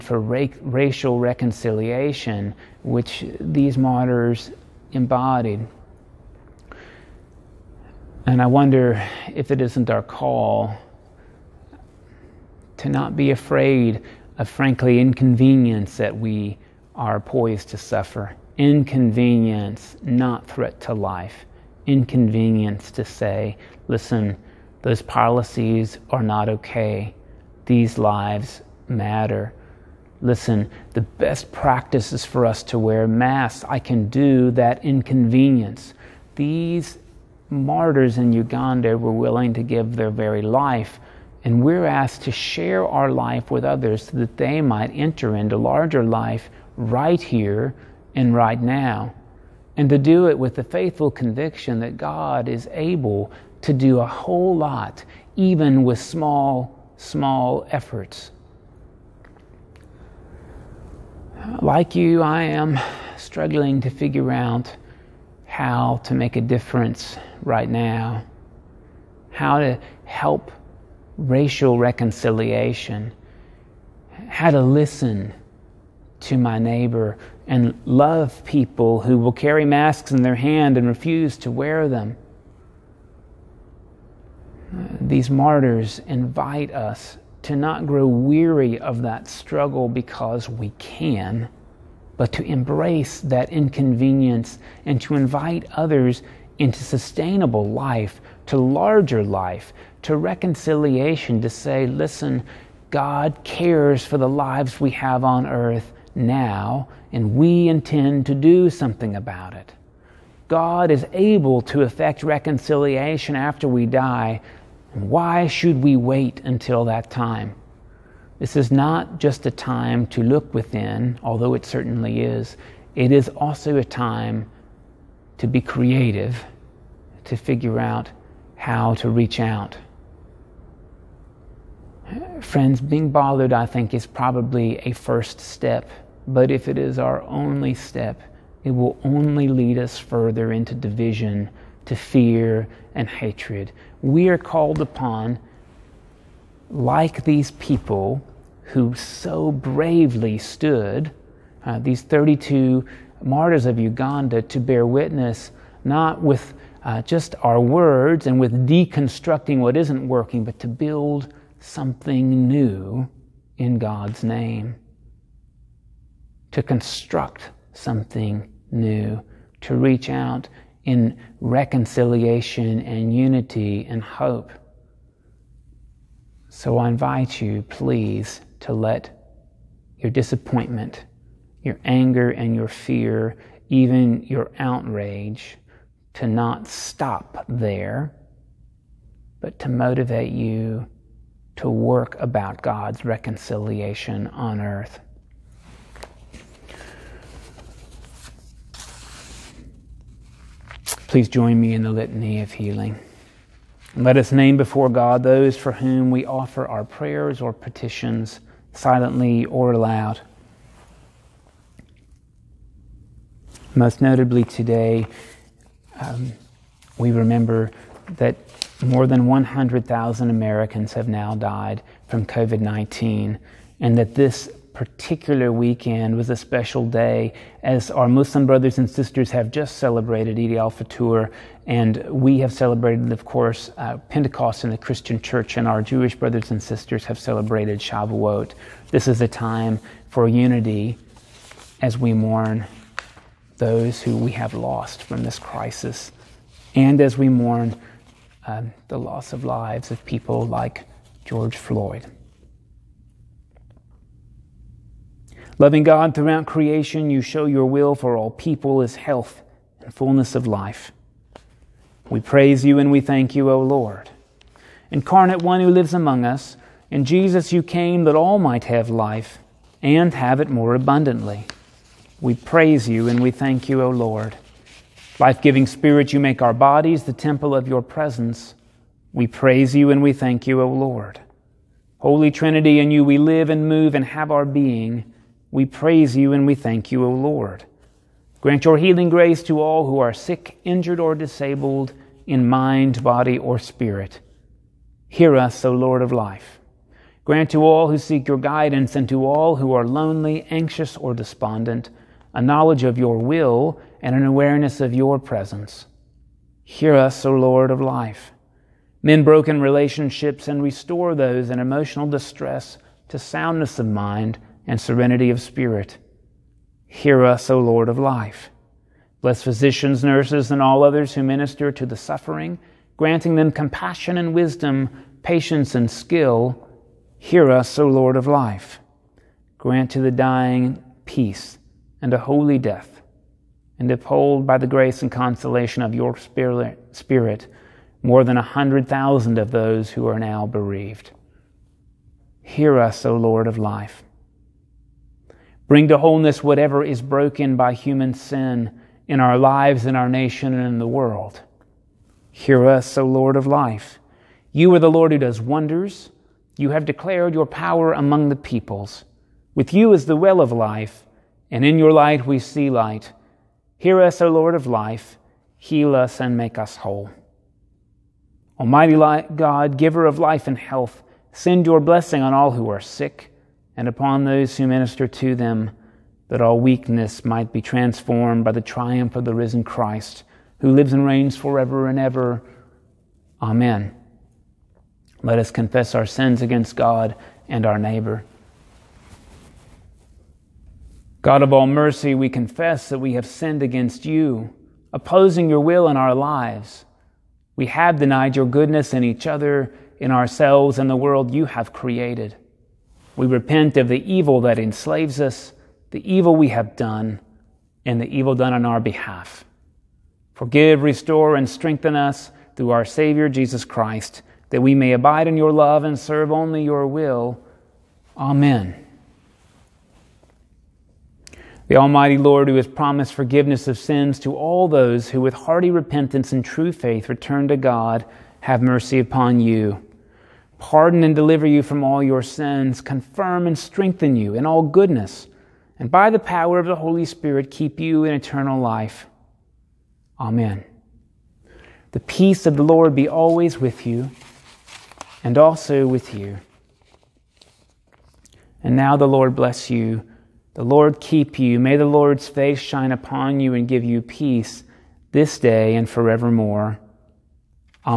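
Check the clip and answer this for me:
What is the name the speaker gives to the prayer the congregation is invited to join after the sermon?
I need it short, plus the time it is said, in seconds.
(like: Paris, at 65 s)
litany of healing, at 201 s.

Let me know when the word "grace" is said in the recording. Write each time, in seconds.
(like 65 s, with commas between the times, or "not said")
289 s, 334 s.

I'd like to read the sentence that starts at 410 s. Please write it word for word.
Forgive, restore, and strengthen us through our Savior Jesus Christ, that we may abide in your love and serve only your will.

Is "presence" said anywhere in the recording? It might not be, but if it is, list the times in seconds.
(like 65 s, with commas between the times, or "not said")
277 s, 305 s.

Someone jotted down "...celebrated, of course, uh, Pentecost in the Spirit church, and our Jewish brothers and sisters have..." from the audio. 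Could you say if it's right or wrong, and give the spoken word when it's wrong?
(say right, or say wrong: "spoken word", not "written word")
wrong: "Christian", not "Spirit".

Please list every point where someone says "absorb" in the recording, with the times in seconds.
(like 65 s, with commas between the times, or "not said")
not said.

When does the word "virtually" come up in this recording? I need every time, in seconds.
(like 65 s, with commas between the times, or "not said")
not said.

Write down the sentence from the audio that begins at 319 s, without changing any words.
Bless physicians, nurses, and all others who minister to the suffering, granting them compassion and wisdom, patience and skill.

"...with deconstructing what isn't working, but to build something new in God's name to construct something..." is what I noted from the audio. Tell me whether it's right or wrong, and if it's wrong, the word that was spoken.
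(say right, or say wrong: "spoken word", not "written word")
right.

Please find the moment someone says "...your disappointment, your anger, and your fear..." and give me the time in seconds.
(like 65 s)
179 s.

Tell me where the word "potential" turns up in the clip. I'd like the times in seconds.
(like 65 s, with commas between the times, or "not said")
not said.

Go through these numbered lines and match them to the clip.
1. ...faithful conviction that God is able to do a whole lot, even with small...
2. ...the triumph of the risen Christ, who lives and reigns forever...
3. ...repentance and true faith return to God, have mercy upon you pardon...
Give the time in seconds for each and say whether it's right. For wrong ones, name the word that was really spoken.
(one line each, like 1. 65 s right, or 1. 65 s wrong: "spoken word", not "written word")
1. 50 s right
2. 378 s right
3. 425 s right.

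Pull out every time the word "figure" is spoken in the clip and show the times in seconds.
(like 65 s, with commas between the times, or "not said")
63 s, 127 s.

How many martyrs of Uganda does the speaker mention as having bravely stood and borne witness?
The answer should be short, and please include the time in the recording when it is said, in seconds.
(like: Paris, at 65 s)
32, at 152 s.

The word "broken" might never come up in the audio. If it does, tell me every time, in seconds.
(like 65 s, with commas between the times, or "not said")
309 s, 347 s.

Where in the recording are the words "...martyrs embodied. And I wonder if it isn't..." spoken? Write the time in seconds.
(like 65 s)
3 s.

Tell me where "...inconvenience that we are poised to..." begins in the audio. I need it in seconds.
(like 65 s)
14 s.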